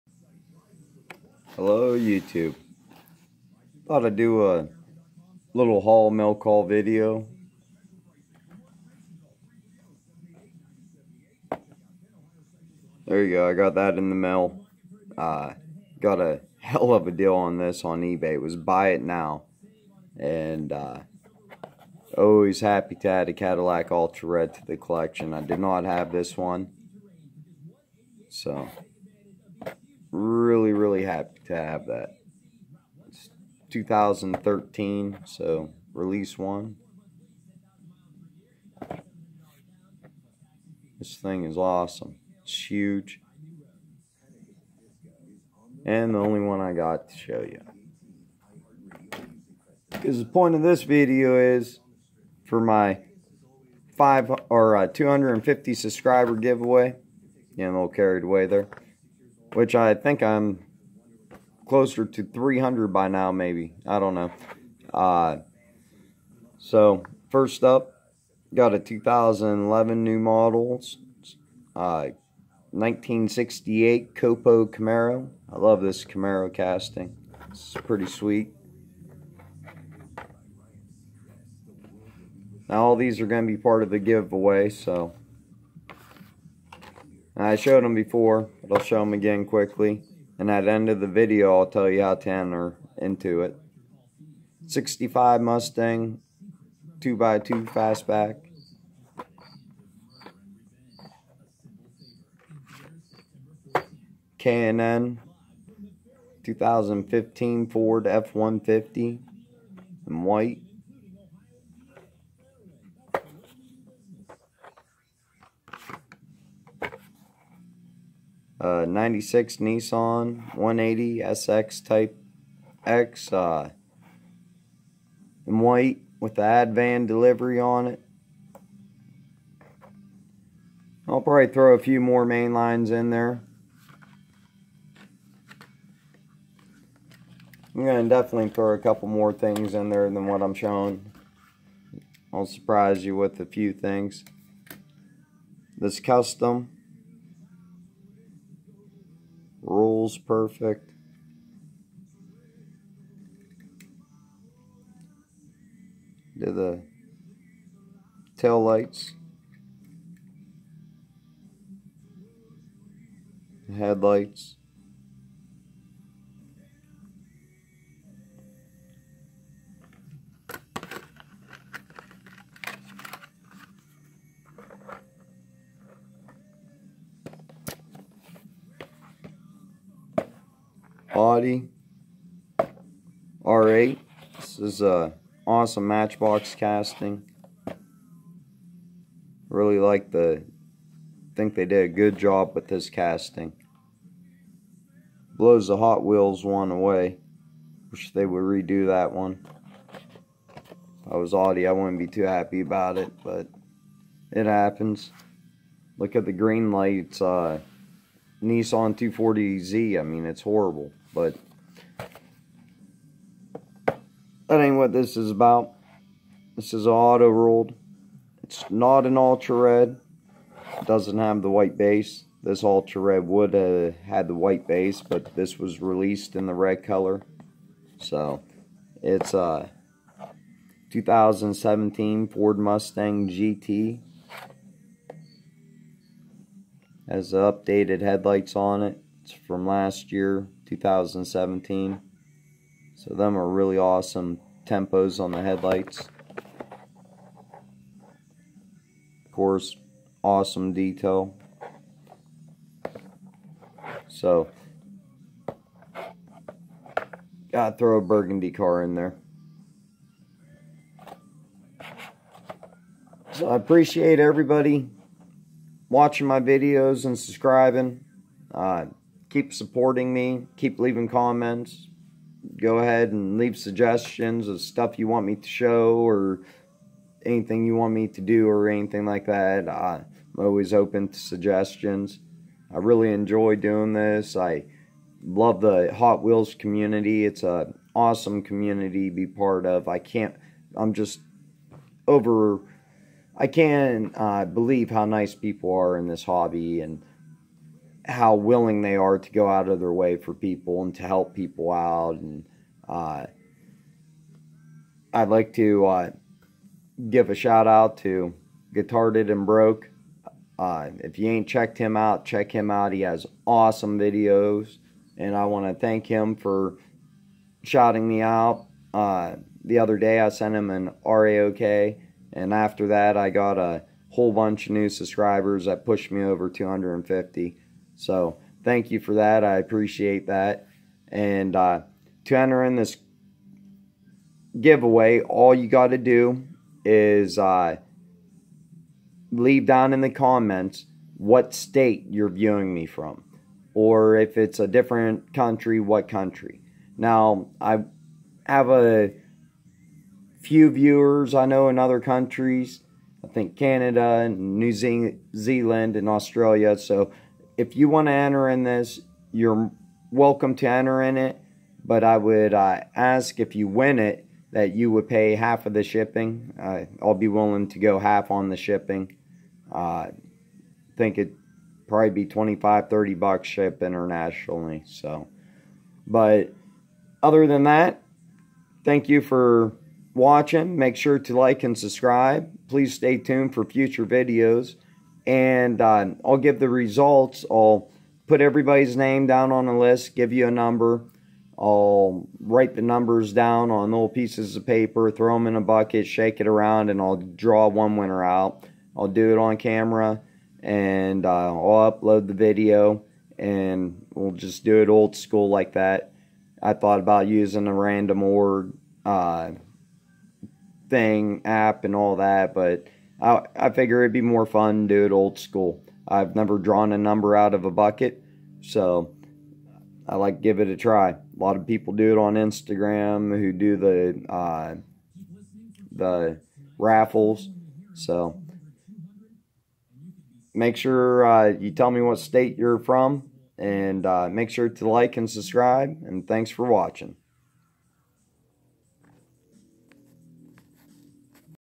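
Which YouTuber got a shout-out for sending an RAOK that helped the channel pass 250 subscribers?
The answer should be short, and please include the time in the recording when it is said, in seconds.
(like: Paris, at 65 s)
Guitar and Broke, at 308 s.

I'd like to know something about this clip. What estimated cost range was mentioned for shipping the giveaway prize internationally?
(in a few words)
25 to 30 dollars.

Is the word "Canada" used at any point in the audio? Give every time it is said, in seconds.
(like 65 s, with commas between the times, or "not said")
353 s.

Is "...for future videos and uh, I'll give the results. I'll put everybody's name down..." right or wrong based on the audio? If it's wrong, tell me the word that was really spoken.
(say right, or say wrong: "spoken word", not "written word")
right.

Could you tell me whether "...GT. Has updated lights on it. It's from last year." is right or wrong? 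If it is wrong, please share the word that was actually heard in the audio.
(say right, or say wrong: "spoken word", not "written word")
wrong: "headlights", not "lights".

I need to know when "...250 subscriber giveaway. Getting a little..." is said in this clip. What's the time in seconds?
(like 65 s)
54 s.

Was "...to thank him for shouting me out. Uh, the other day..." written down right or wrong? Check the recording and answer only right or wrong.
right.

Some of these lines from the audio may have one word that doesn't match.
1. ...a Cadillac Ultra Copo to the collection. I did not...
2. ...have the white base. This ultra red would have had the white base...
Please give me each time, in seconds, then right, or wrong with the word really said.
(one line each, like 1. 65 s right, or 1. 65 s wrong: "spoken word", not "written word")
1. 23 s wrong: "Red", not "Copo"
2. 221 s right.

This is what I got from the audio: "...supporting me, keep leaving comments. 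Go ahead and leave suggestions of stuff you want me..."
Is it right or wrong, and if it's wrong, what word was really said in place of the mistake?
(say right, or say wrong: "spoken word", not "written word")
right.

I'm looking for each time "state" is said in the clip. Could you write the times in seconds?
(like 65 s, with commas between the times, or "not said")
341 s, 432 s.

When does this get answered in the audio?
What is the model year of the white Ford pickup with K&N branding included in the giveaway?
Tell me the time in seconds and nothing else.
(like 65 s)
106 s.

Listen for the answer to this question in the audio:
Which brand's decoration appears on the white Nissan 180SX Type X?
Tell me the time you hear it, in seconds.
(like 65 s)
126 s.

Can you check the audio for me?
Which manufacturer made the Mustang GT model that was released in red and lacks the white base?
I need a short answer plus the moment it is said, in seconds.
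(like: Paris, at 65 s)
Auto World, at 216 s.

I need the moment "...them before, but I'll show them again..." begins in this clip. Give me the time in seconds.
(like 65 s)
87 s.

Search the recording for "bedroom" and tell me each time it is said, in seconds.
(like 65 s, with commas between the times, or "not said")
not said.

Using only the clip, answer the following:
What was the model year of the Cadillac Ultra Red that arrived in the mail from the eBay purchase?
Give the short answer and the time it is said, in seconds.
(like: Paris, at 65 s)
2013, at 33 s.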